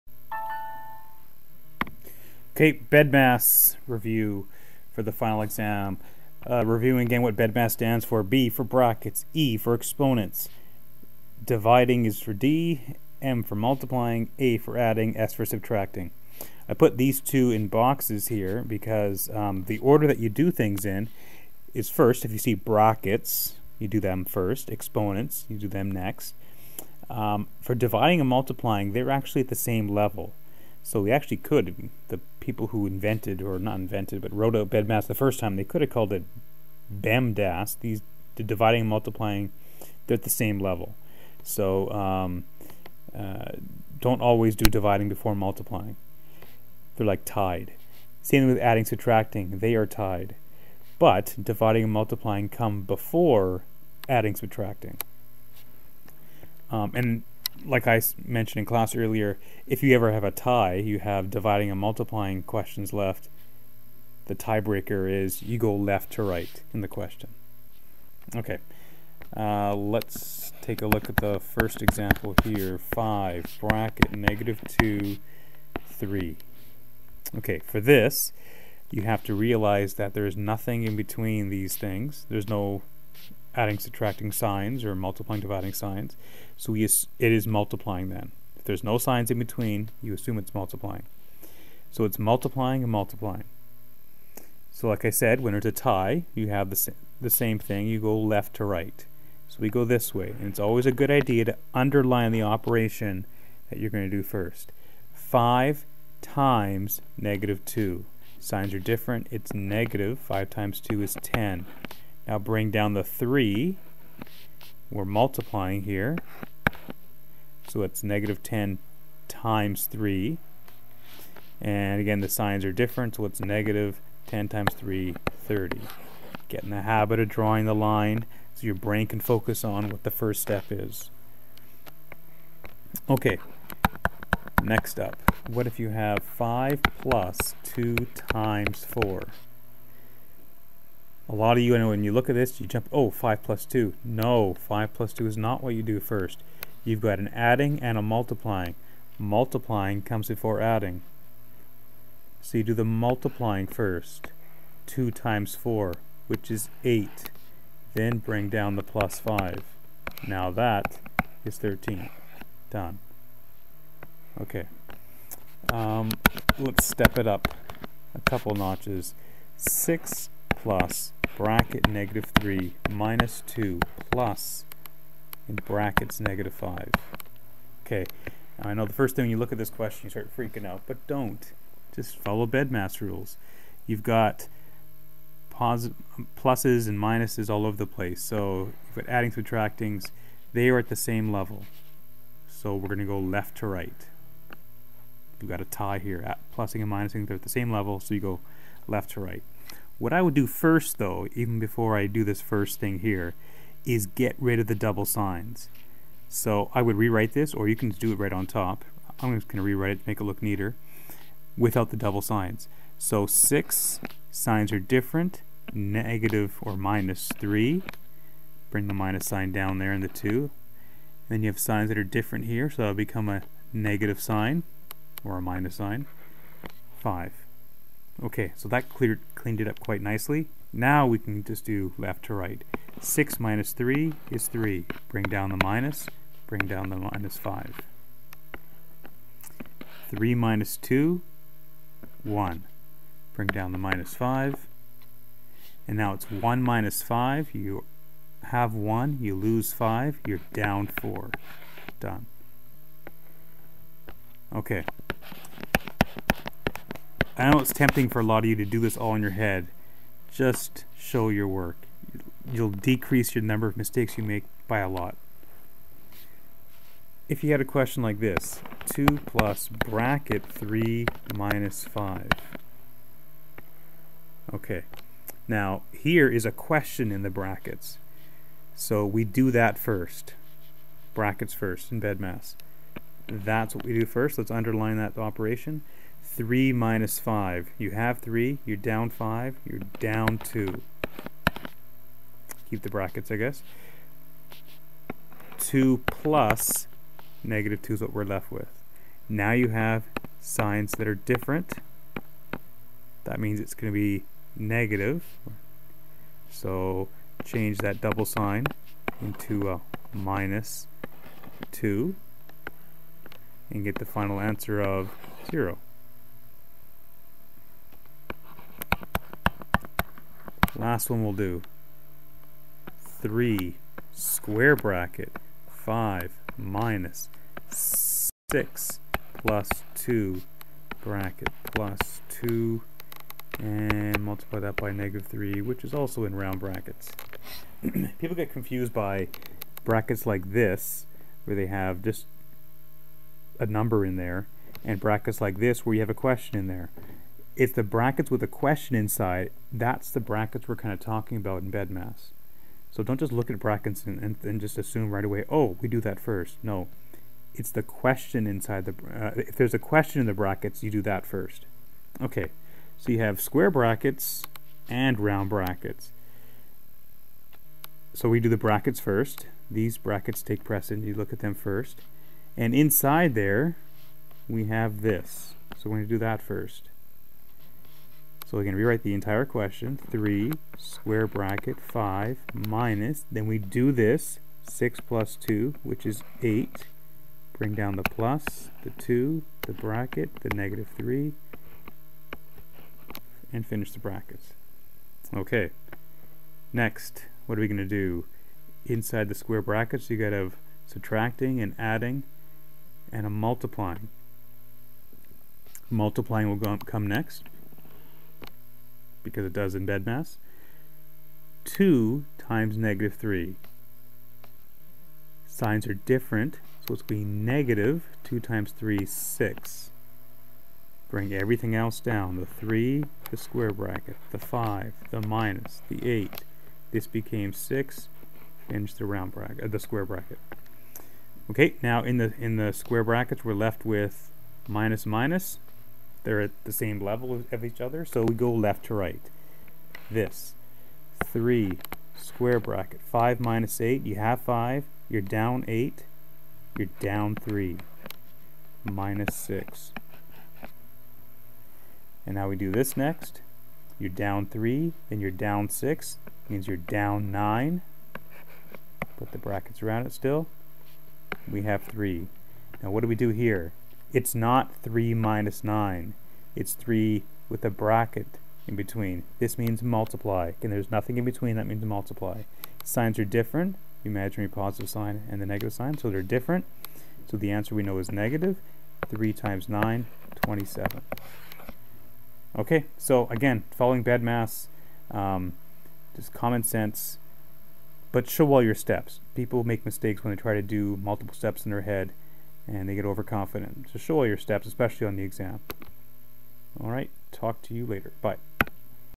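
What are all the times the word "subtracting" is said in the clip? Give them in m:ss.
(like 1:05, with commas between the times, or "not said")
0:15, 0:48, 0:54, 1:23, 3:09, 6:40.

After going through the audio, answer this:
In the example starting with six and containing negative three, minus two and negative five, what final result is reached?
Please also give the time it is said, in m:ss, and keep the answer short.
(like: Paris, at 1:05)
-4, at 4:10.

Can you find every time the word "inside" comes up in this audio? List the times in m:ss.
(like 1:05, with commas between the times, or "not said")
5:48, 5:58, 6:12, 6:38.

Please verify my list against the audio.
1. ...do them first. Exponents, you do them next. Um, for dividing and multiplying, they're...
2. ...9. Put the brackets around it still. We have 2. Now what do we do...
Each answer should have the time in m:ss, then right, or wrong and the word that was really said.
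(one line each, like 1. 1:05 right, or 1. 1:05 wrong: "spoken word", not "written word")
1. 0:23 right
2. 7:37 wrong: "3", not "2".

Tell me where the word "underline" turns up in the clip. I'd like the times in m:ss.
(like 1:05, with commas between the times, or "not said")
1:41, 4:44.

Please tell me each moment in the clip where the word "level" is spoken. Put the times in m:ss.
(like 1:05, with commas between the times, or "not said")
0:29, 0:40, 3:11, 3:17, 7:17.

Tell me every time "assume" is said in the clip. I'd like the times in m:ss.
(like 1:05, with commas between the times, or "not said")
1:30, 5:54.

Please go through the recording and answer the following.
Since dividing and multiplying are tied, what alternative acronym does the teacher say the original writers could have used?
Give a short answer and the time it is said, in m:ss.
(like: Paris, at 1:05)
BEMDAS, at 0:36.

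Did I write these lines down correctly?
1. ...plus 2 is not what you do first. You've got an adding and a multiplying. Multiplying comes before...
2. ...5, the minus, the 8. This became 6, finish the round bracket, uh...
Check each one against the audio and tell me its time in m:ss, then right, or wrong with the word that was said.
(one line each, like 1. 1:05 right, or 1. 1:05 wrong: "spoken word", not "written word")
1. 2:24 right
2. 7:04 right.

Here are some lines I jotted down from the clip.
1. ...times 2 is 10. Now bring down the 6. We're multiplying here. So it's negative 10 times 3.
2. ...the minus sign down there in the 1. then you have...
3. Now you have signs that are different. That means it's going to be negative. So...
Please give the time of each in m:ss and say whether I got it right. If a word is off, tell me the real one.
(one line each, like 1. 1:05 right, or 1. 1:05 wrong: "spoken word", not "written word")
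1. 1:50 wrong: "3", not "6"
2. 3:38 wrong: "2", not "1"
3. 4:59 right.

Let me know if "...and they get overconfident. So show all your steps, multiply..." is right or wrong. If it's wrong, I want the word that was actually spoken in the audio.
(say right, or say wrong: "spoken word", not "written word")
wrong: "especially", not "multiply".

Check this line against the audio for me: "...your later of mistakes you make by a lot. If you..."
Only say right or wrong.
wrong.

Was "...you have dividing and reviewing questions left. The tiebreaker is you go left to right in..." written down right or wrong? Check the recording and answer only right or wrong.
wrong.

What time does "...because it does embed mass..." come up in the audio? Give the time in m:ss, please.
6:49.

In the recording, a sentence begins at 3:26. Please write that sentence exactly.
So I would rewrite this, or you can do it right on top.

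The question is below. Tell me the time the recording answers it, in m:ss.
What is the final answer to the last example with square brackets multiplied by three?
8:00.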